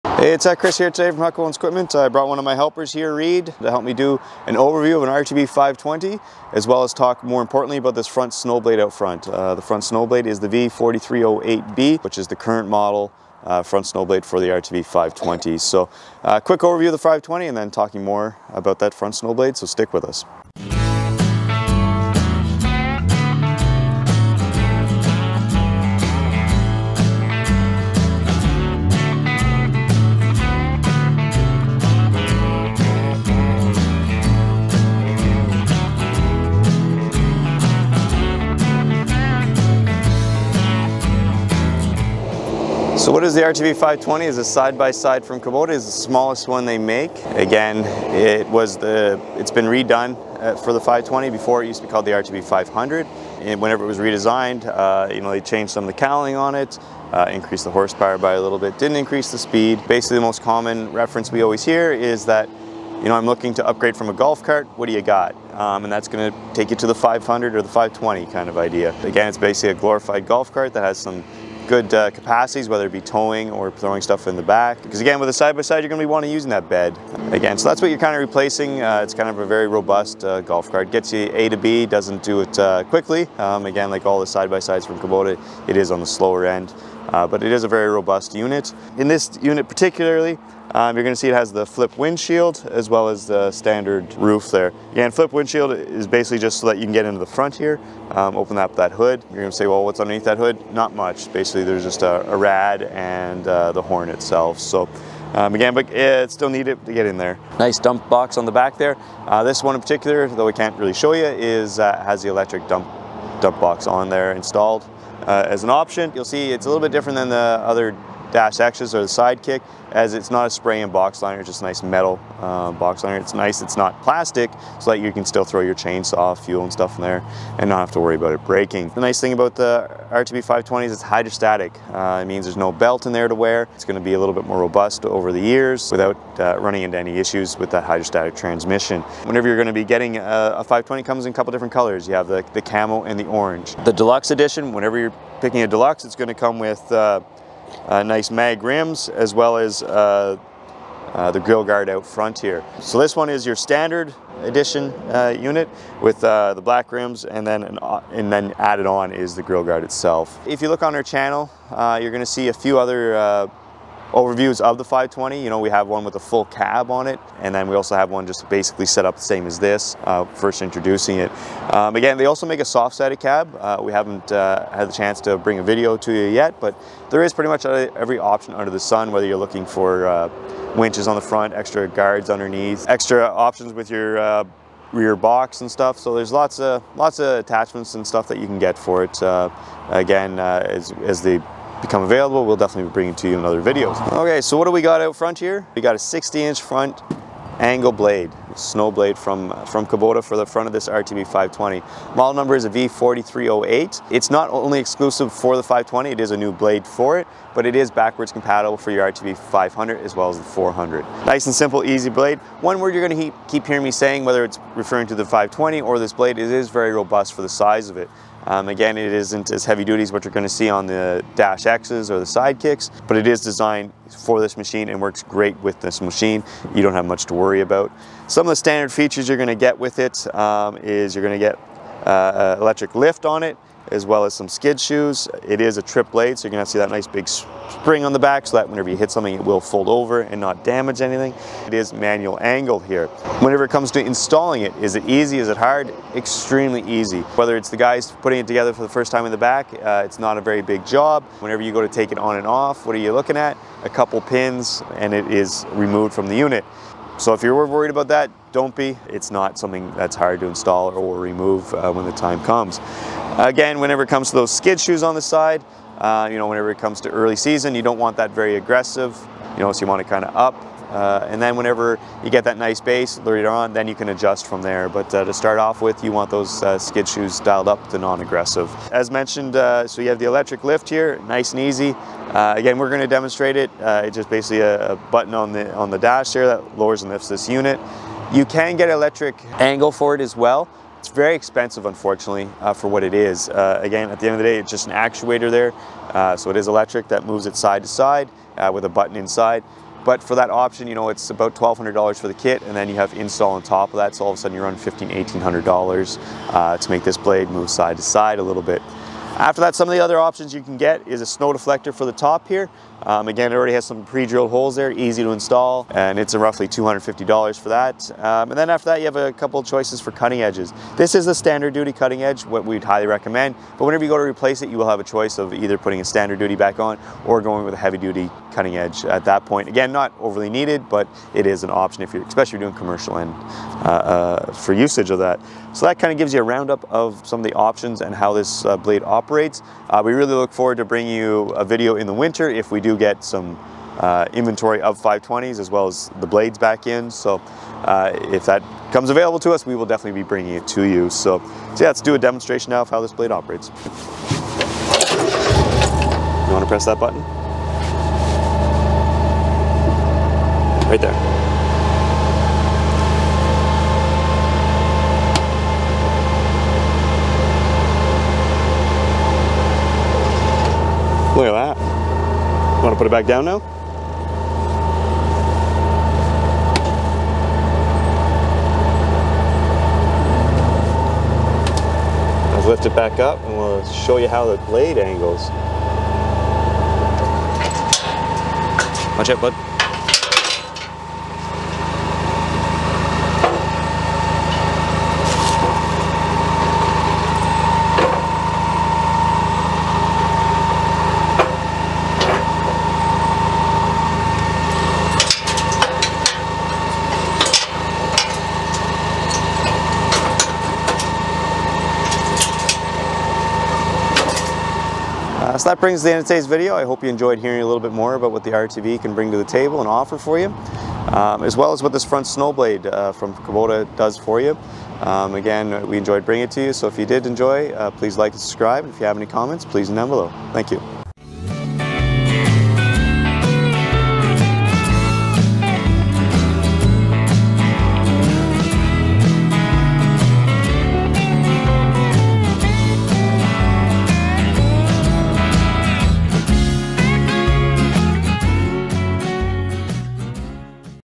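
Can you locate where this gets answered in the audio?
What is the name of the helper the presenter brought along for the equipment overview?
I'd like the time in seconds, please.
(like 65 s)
3 s.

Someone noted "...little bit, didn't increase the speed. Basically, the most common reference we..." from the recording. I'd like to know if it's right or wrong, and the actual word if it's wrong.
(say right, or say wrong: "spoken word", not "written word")
right.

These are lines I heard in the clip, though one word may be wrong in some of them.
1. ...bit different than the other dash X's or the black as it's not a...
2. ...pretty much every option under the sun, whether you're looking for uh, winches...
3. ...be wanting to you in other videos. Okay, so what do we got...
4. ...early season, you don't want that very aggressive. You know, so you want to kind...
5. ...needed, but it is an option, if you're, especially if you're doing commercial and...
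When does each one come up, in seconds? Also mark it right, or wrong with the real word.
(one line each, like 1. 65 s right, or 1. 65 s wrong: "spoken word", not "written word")
1. 116 s wrong: "sidekick", not "black"
2. 177 s right
3. 192 s wrong: "bringing", not "wanting"
4. 267 s right
5. 330 s right.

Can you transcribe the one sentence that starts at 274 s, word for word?
But uh, to start off with, you want those uh, skid shoes dialed up to non-aggressive.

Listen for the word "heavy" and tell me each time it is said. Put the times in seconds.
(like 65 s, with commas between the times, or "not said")
219 s, 327 s.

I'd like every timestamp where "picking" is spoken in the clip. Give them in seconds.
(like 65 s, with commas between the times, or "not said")
145 s.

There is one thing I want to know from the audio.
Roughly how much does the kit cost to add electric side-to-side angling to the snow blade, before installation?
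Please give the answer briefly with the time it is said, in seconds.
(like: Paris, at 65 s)
$1,200, at 301 s.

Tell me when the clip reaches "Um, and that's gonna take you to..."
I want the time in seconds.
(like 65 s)
65 s.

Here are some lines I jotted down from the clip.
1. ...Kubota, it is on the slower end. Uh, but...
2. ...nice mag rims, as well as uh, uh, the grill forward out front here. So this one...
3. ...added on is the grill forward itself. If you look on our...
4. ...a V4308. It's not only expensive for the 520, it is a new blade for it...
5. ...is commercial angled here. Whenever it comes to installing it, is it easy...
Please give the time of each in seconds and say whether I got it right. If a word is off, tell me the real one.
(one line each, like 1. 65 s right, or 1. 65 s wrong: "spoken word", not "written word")
1. 84 s right
2. 148 s wrong: "guard", not "forward"
3. 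158 s wrong: "guard", not "forward"
4. 202 s wrong: "exclusive", not "expensive"
5. 241 s wrong: "manual", not "commercial".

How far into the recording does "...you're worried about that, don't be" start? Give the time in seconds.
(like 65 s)
257 s.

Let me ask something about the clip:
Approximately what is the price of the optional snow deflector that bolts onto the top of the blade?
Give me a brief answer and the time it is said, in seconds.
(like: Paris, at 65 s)
$250, at 316 s.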